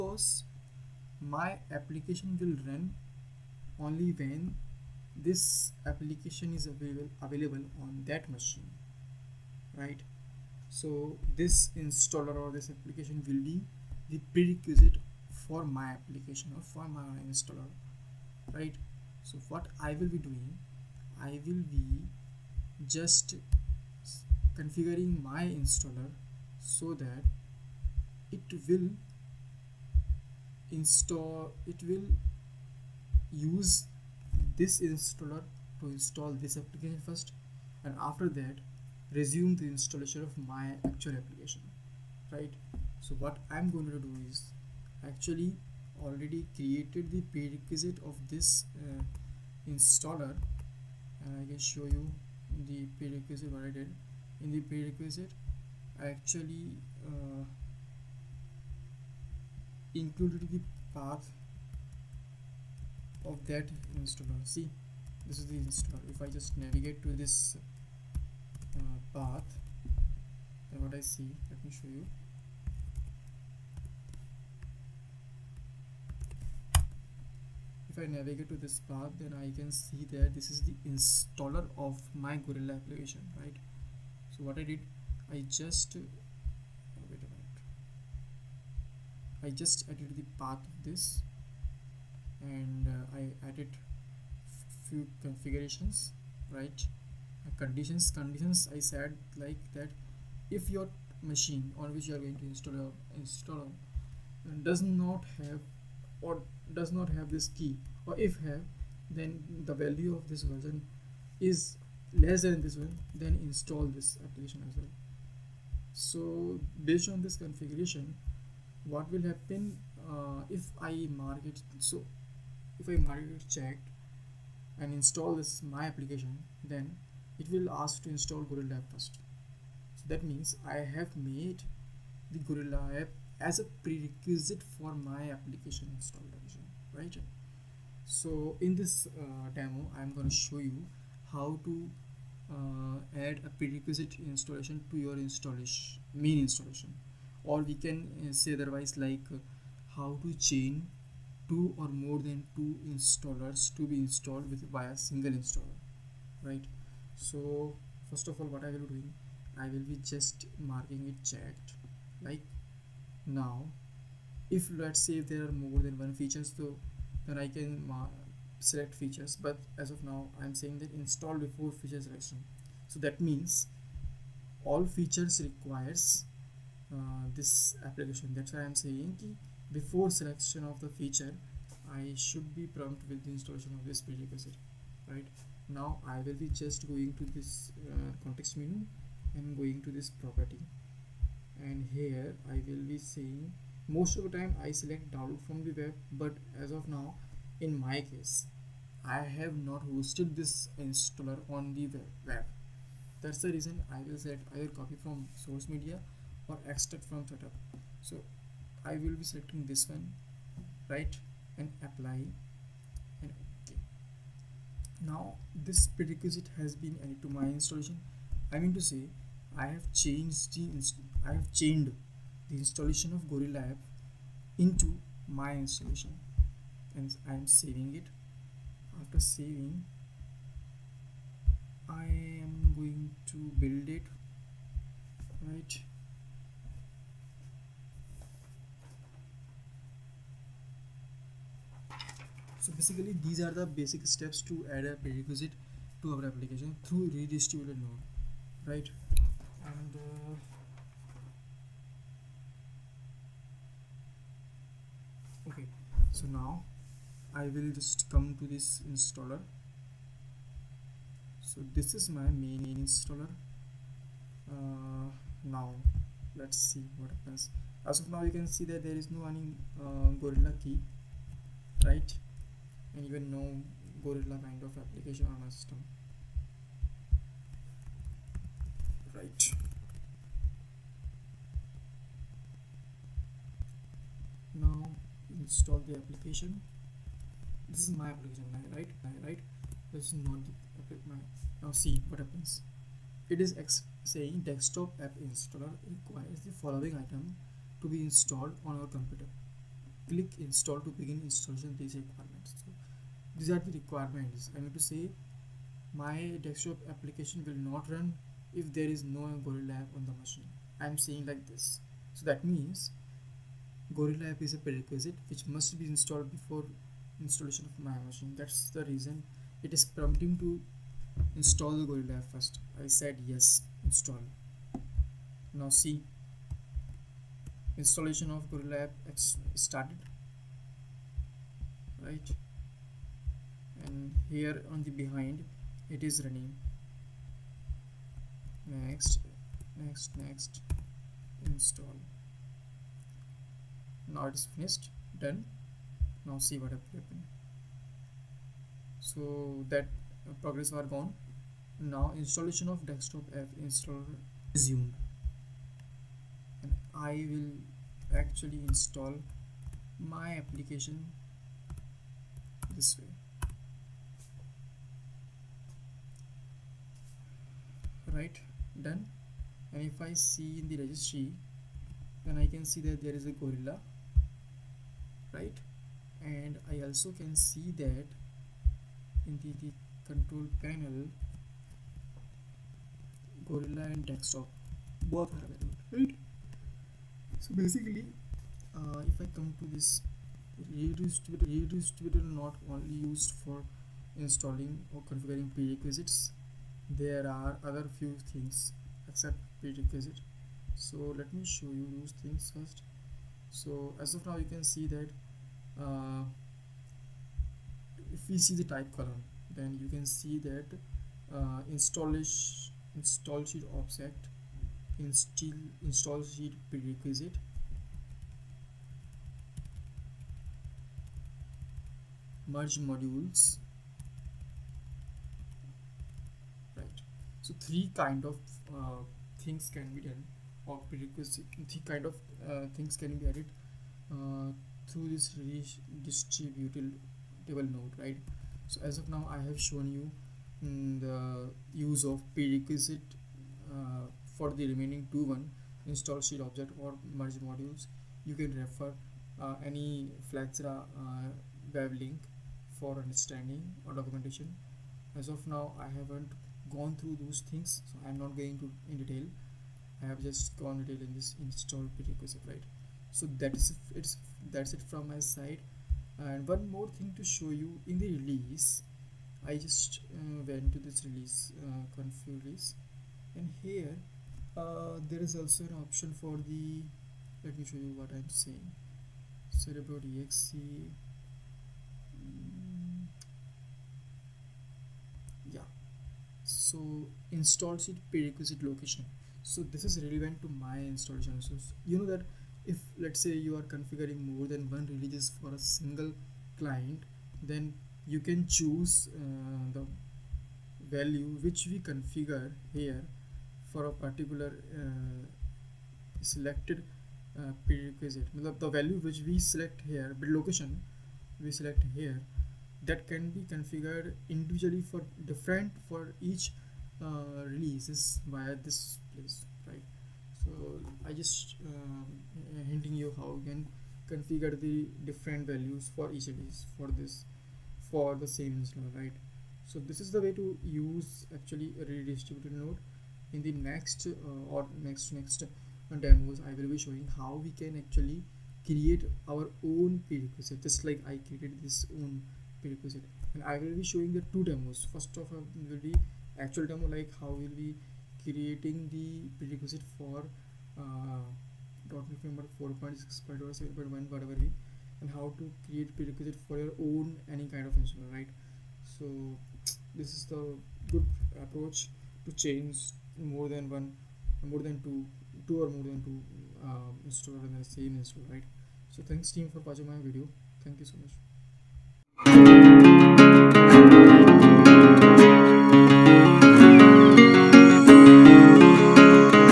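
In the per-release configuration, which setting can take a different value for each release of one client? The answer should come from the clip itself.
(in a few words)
InstallShield prerequisite location.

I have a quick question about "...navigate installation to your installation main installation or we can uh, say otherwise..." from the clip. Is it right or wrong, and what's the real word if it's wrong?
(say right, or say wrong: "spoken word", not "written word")
wrong: "prerequisite", not "navigate".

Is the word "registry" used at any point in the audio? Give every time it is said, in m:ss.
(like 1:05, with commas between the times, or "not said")
6:10.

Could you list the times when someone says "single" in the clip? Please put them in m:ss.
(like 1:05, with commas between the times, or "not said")
2:34, 8:15.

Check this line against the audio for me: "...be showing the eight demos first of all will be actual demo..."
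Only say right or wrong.
wrong.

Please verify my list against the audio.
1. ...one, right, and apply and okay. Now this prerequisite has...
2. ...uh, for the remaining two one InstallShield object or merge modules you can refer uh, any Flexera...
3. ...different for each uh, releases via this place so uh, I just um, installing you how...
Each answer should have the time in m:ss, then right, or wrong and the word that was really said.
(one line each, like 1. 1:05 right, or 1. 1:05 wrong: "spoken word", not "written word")
1. 3:29 right
2. 7:23 right
3. 8:35 wrong: "hinting", not "installing".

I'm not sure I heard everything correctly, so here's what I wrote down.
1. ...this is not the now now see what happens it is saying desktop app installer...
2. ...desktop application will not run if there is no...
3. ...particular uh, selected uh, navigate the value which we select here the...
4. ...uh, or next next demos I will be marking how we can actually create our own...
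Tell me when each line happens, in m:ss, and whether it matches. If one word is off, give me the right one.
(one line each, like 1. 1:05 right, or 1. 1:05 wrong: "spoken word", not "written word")
1. 4:49 right
2. 5:06 right
3. 8:23 wrong: "prerequisite", not "navigate"
4. 8:54 wrong: "showing", not "marking".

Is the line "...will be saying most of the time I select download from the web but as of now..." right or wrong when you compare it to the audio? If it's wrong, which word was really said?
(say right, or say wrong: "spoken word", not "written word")
right.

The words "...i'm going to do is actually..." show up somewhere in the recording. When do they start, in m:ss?
0:43.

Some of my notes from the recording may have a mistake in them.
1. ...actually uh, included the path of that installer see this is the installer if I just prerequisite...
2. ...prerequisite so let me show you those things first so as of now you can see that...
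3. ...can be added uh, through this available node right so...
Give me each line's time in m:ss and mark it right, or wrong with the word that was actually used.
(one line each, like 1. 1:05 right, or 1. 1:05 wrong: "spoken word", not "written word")
1. 0:56 wrong: "navigate", not "prerequisite"
2. 6:39 right
3. 7:12 wrong: "table", not "available".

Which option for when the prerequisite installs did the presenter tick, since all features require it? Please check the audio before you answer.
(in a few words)
Install before feature selection.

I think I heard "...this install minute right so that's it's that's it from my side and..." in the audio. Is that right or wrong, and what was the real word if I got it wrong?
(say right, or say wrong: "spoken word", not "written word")
wrong: "prerequisite", not "minute".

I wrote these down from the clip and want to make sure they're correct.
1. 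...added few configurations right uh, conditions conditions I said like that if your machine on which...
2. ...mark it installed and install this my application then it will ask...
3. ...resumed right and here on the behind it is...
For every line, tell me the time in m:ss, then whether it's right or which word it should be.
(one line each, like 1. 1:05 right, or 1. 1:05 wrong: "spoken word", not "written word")
1. 1:33 right
2. 2:03 wrong: "checked", not "installed"
3. 5:29 wrong: "started", not "resumed".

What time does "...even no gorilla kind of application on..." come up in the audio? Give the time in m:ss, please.
4:33.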